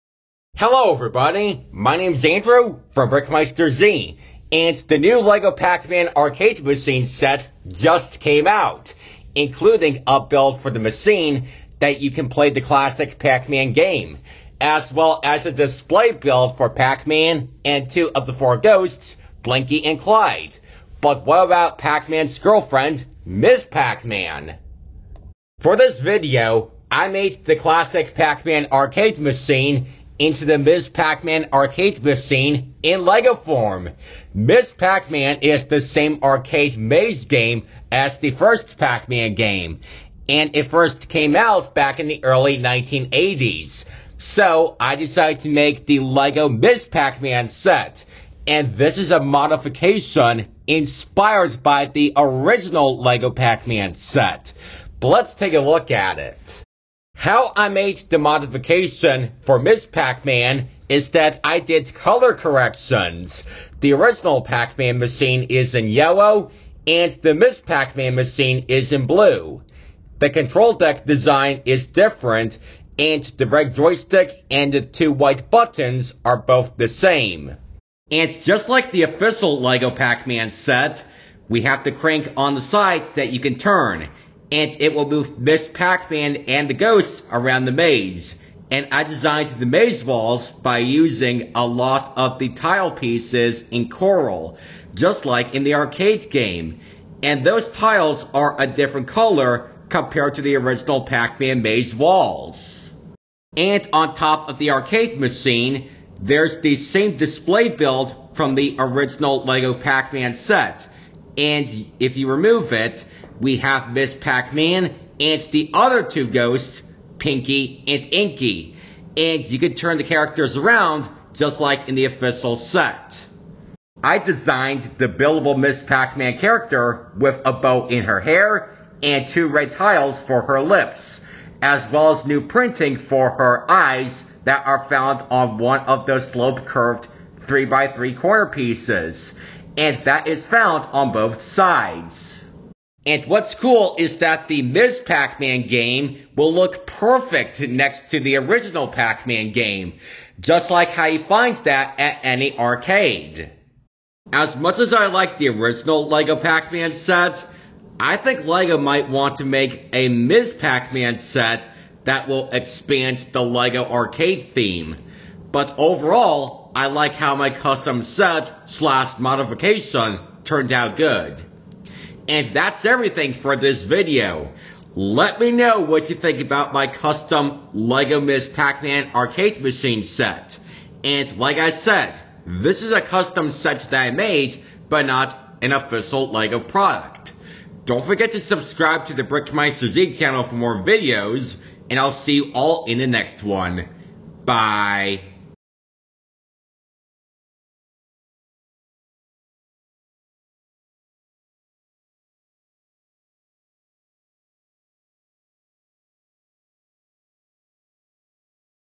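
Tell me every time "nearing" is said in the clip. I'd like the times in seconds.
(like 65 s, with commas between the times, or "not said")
not said.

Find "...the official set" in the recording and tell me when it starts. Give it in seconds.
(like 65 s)
121 s.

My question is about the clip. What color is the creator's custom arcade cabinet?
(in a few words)
Blue.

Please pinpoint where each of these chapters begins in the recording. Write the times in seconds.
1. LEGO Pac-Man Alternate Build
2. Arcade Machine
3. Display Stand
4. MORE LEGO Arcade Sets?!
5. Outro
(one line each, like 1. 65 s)
1. 26 s
2. 58 s
3. 104 s
4. 143 s
5. 172 s.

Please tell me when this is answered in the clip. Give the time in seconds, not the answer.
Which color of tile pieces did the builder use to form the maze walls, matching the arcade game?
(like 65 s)
93 s.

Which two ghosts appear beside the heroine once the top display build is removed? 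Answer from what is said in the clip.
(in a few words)
Pinky and Inky.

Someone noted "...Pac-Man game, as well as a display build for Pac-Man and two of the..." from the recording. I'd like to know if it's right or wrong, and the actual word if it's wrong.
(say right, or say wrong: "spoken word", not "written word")
right.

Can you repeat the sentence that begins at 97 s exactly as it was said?
And those tiles are a different color compared to the original Pac-Man maze walls.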